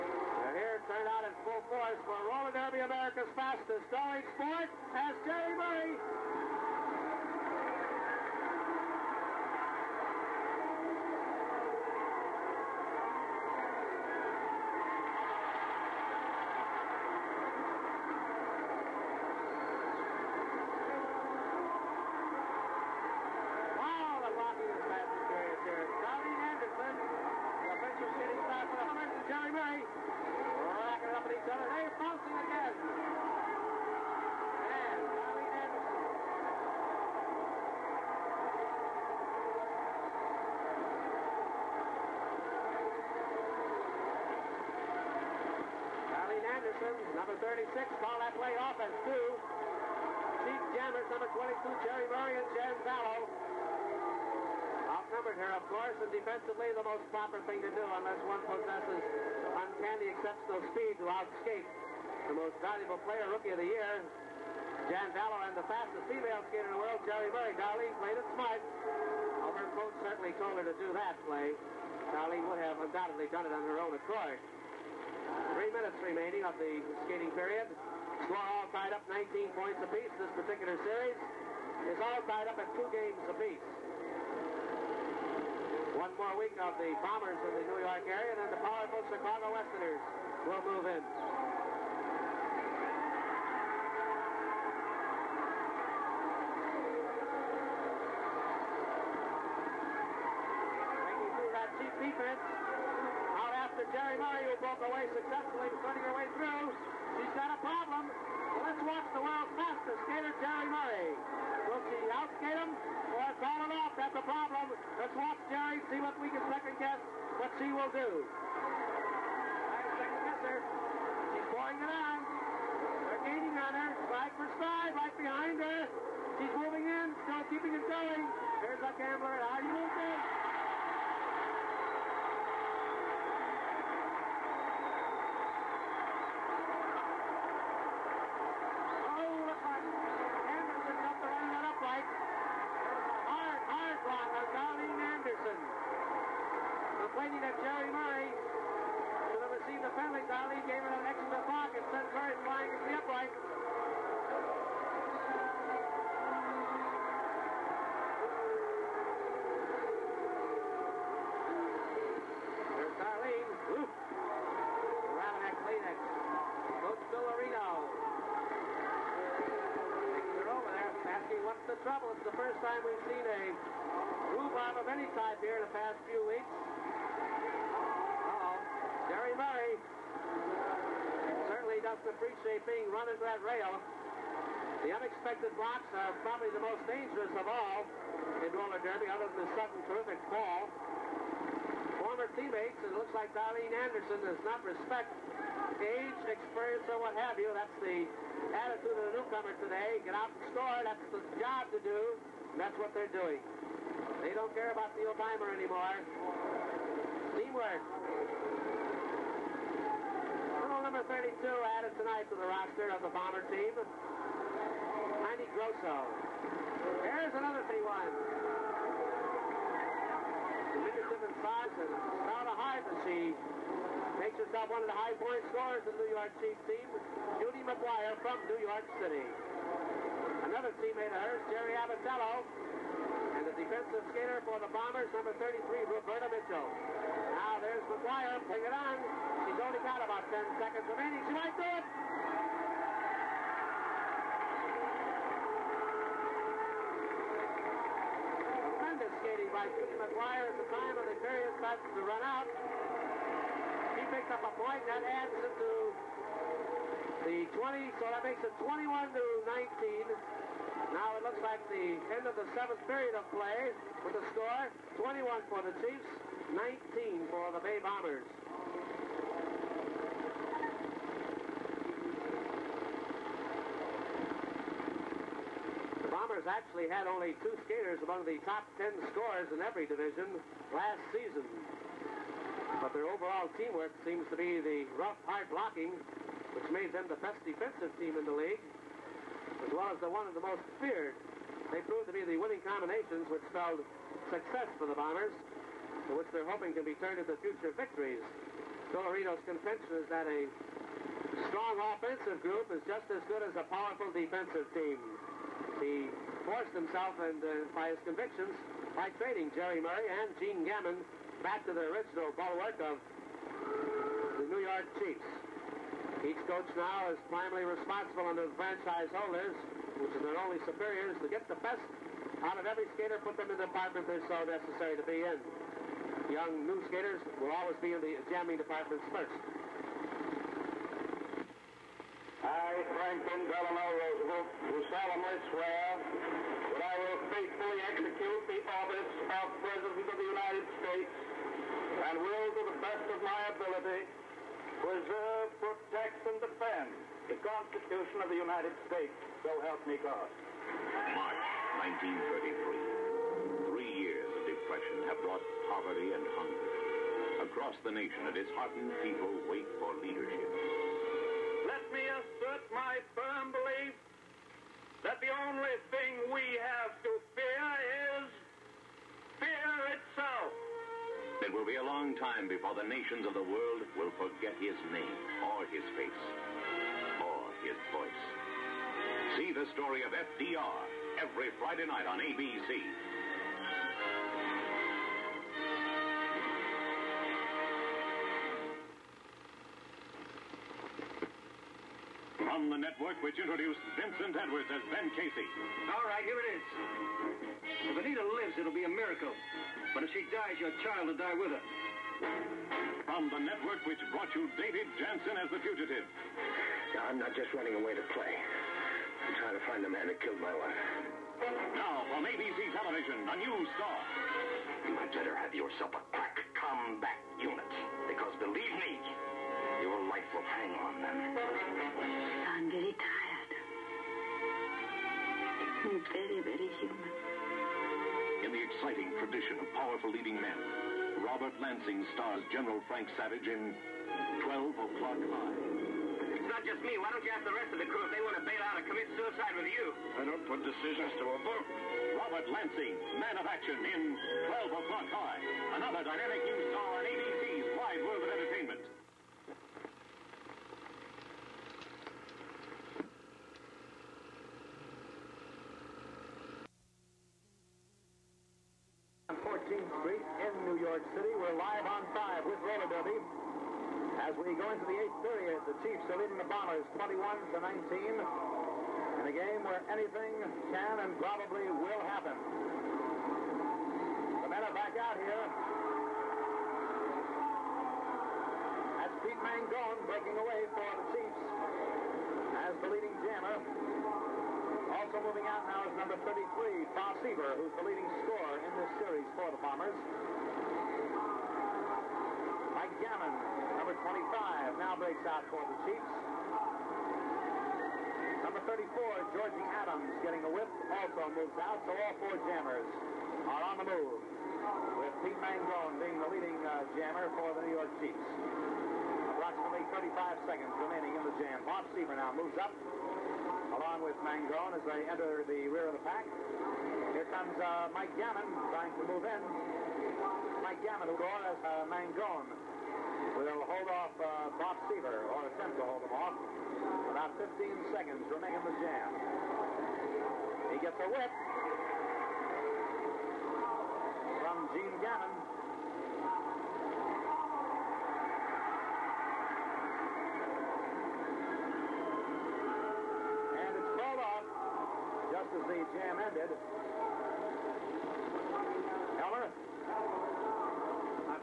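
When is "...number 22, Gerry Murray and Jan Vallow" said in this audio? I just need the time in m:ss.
0:51.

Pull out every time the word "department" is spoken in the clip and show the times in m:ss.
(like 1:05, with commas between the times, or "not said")
5:23, 5:28.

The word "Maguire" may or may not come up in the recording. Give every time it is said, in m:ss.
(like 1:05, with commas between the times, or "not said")
3:47, 3:57, 4:09.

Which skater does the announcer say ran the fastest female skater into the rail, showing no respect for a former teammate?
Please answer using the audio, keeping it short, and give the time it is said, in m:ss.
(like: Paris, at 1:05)
Darlene Anderson, at 3:13.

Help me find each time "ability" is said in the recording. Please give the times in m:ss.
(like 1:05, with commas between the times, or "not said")
5:43.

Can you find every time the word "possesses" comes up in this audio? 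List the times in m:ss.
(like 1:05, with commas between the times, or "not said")
0:58.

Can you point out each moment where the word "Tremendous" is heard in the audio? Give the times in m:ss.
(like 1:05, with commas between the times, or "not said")
4:08.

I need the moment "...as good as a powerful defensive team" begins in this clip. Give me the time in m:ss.
5:03.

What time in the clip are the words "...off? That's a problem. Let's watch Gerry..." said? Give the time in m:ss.
1:53.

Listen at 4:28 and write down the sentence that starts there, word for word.
The Bombers actually had only two skaters among the top 10 scorers in every division last season.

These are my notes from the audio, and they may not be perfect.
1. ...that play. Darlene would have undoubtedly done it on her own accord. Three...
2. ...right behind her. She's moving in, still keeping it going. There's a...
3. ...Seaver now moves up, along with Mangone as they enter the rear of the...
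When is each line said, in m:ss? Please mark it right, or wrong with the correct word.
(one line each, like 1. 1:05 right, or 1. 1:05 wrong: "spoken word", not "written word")
1. 1:10 right
2. 2:04 right
3. 8:31 right.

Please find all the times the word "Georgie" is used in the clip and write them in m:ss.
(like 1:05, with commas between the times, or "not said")
8:19.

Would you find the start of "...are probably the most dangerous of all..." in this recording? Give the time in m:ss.
3:05.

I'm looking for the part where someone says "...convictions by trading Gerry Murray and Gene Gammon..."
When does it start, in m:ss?
5:08.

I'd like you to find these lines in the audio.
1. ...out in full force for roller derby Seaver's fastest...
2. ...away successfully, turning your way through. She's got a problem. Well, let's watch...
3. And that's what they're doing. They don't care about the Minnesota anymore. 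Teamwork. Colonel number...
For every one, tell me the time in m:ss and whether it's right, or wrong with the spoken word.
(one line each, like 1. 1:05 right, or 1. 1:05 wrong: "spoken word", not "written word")
1. 0:01 wrong: "America", not "Seaver"
2. 1:44 right
3. 3:22 wrong: "Obama", not "Minnesota".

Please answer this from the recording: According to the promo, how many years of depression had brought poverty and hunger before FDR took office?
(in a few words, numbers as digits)
3.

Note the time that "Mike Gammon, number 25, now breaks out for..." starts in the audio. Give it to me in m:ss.
8:09.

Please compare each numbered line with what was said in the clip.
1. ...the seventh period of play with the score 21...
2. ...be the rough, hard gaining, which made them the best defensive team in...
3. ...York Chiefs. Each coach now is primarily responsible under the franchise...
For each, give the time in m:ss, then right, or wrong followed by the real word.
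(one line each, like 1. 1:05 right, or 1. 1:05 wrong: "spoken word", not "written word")
1. 4:22 right
2. 4:44 wrong: "blocking", not "gaining"
3. 5:14 right.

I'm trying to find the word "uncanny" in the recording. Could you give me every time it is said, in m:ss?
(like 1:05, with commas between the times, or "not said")
0:59.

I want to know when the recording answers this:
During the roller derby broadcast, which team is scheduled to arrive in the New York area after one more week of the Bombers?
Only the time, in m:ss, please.
1:29.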